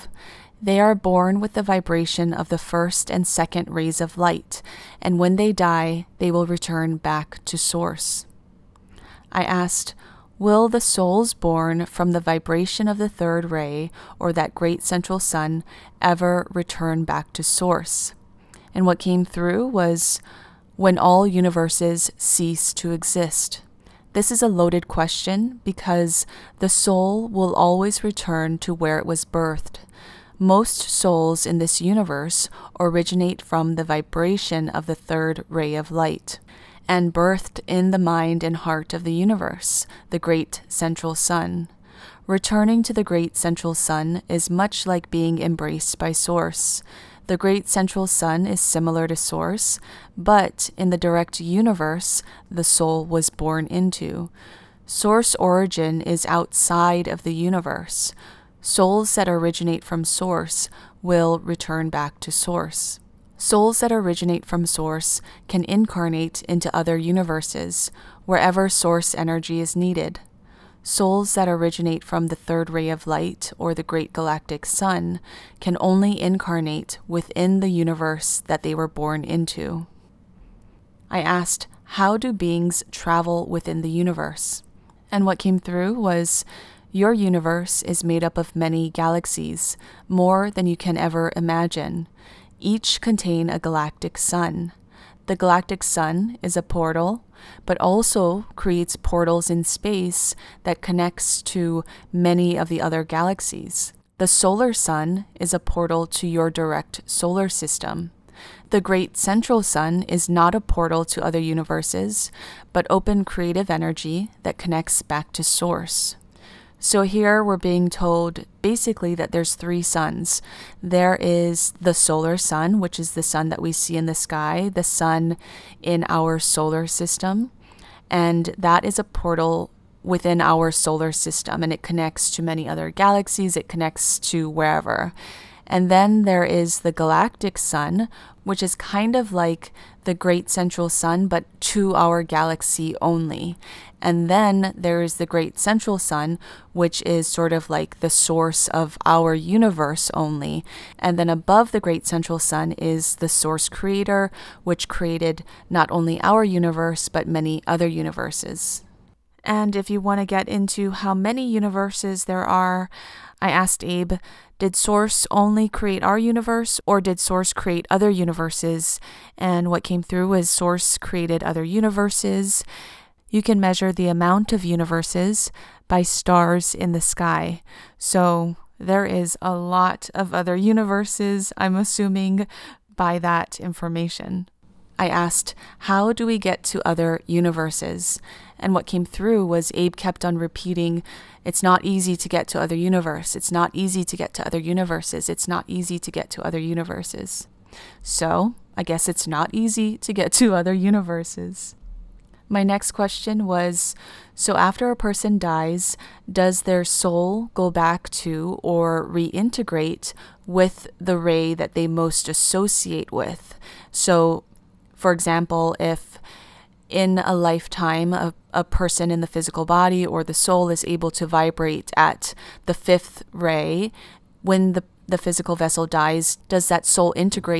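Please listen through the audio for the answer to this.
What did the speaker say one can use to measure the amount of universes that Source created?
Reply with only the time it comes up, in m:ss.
2:56.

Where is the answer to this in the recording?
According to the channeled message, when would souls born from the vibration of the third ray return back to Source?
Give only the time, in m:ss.
0:20.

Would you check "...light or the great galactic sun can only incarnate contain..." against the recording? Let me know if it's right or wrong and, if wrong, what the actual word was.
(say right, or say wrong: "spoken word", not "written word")
wrong: "within", not "contain".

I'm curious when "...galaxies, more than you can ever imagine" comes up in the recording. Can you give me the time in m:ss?
1:28.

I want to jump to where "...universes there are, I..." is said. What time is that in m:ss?
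2:41.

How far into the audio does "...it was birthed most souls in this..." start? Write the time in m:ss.
0:28.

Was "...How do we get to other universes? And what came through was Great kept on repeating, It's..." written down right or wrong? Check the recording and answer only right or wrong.
wrong.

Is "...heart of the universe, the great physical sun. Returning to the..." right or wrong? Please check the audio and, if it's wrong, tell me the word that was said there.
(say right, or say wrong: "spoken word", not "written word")
wrong: "central", not "physical".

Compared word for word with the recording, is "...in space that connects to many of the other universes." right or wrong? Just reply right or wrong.
wrong.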